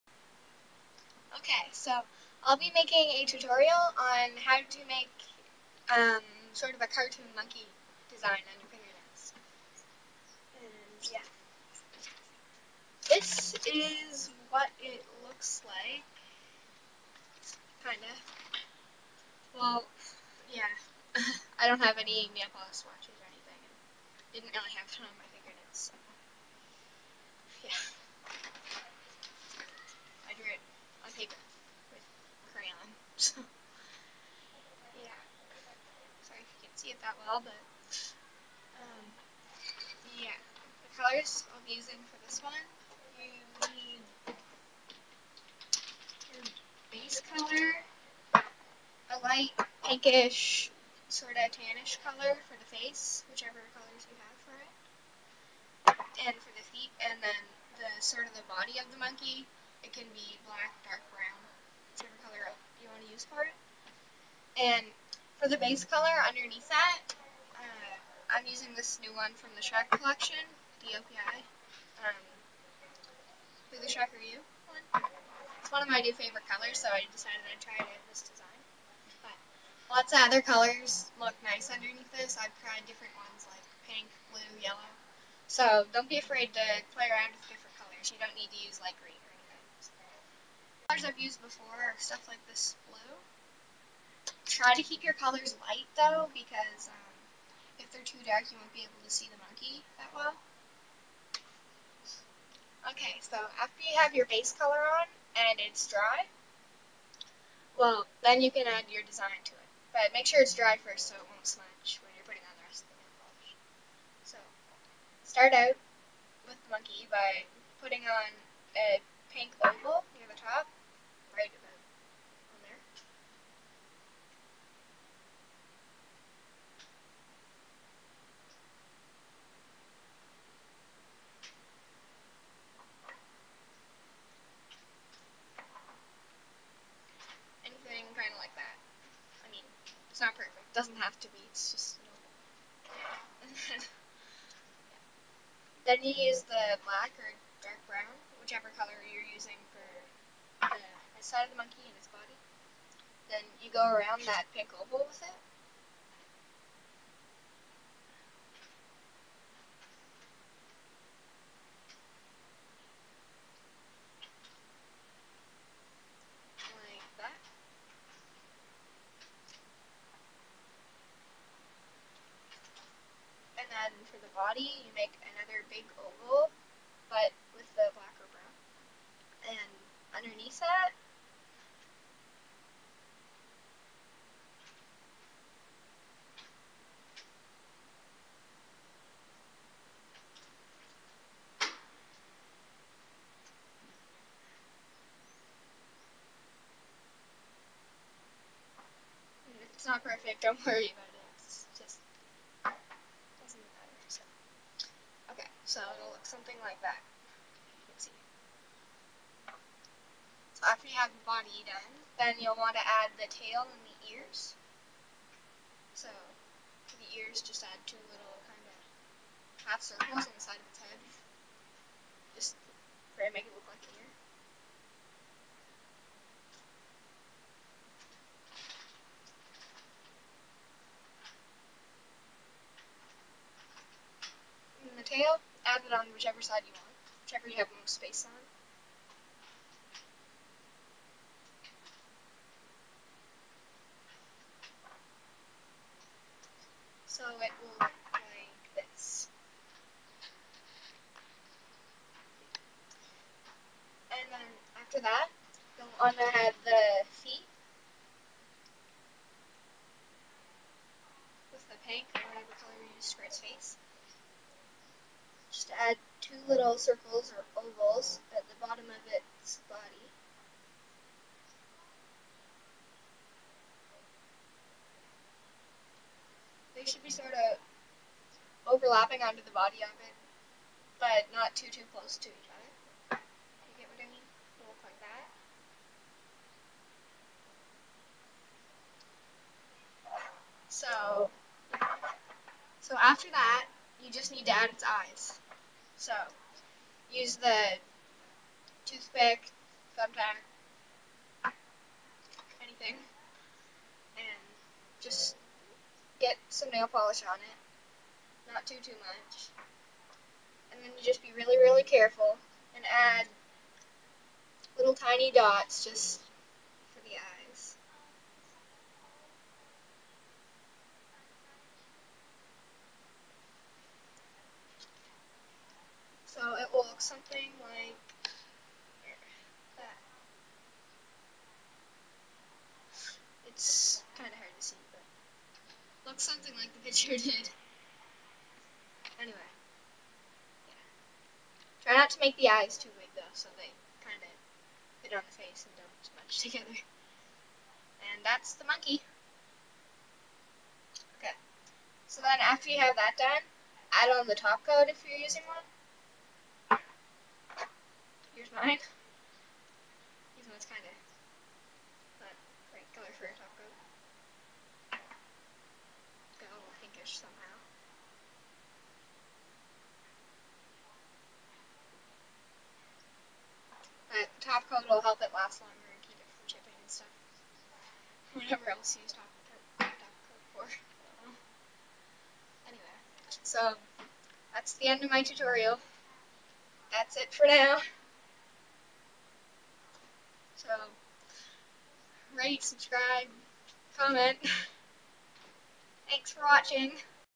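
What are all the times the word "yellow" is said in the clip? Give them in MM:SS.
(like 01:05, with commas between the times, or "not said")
01:24.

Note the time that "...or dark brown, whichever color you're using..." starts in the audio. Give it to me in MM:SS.
02:27.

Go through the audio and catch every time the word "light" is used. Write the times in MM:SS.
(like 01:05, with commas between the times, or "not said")
00:49, 01:35.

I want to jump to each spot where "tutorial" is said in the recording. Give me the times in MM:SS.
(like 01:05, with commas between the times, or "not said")
00:03, 06:25.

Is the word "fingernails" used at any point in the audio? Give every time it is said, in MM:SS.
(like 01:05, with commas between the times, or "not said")
00:08, 00:25.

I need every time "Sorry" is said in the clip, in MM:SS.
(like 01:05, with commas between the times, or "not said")
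00:36.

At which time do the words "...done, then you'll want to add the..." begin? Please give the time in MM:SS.
03:31.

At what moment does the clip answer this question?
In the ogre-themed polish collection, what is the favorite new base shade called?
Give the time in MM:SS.
01:13.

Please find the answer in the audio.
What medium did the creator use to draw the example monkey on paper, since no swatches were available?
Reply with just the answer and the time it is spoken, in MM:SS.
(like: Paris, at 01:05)
crayon, at 00:32.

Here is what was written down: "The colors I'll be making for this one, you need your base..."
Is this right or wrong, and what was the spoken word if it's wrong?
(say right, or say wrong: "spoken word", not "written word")
wrong: "using", not "making".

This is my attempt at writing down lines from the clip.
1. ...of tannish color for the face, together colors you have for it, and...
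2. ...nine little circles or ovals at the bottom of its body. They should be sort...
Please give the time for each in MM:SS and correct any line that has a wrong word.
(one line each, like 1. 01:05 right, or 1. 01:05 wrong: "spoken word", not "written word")
1. 00:51 wrong: "whichever", not "together"
2. 04:26 wrong: "two", not "nine".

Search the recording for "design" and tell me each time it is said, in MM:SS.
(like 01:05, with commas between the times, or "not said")
00:08, 01:18, 01:49.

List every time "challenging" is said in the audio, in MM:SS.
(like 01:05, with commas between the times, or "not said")
not said.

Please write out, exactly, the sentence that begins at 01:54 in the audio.
So, start out with the monkey by putting on a pink oval near the top.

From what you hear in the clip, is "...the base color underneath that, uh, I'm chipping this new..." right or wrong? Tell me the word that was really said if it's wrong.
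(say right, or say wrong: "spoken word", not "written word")
wrong: "using", not "chipping".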